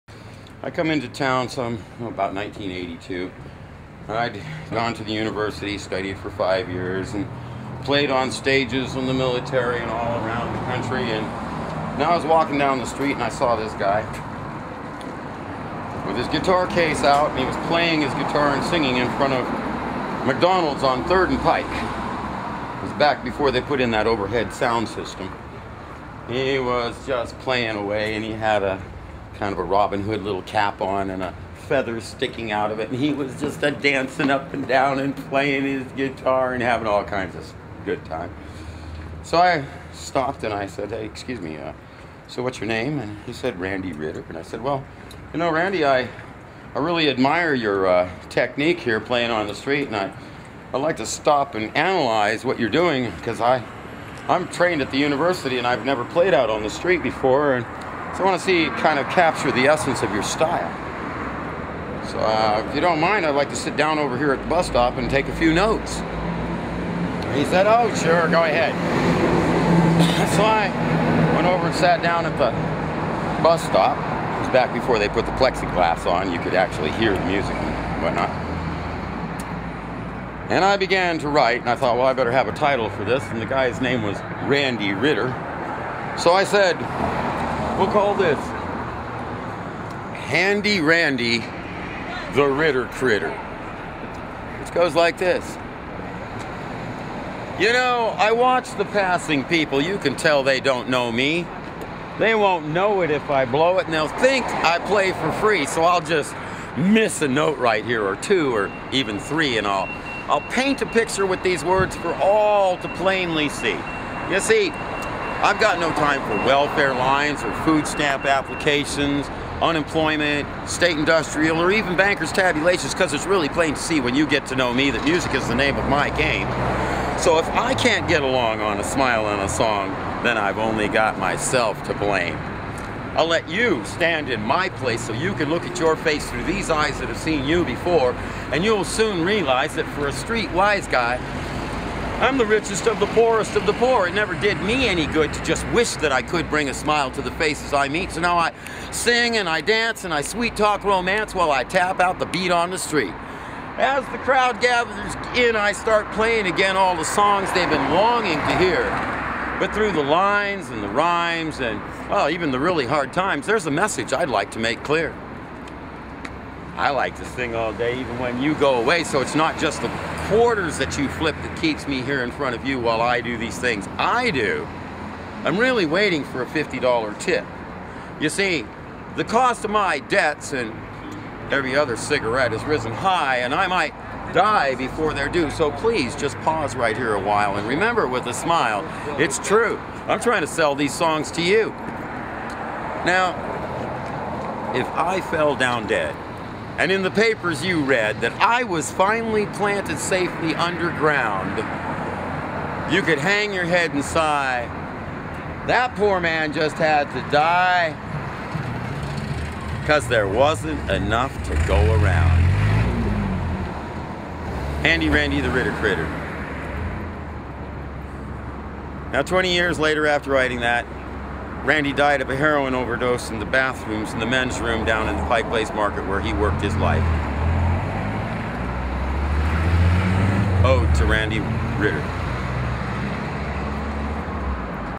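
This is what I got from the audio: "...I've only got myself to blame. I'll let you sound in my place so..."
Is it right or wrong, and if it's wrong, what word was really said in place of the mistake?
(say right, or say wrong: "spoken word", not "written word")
wrong: "stand", not "sound".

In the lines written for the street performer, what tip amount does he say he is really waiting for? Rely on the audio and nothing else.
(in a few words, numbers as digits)
$50.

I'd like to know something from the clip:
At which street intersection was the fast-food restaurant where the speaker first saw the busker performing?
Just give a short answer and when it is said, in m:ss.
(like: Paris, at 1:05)
Third and Pike, at 0:21.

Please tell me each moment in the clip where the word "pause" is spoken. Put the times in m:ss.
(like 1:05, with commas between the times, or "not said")
3:06.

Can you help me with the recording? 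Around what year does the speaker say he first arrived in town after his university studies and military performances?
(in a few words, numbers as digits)
1982.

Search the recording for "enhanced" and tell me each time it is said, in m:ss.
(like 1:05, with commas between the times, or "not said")
not said.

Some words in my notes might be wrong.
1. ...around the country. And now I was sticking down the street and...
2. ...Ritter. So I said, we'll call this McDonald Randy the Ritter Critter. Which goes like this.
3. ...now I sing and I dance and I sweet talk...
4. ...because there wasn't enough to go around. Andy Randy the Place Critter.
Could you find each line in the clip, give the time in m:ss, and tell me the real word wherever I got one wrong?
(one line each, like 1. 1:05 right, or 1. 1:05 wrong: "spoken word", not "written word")
1. 0:10 wrong: "walking", not "sticking"
2. 1:24 wrong: "Handy", not "McDonald"
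3. 2:28 right
4. 3:29 wrong: "Ritter", not "Place".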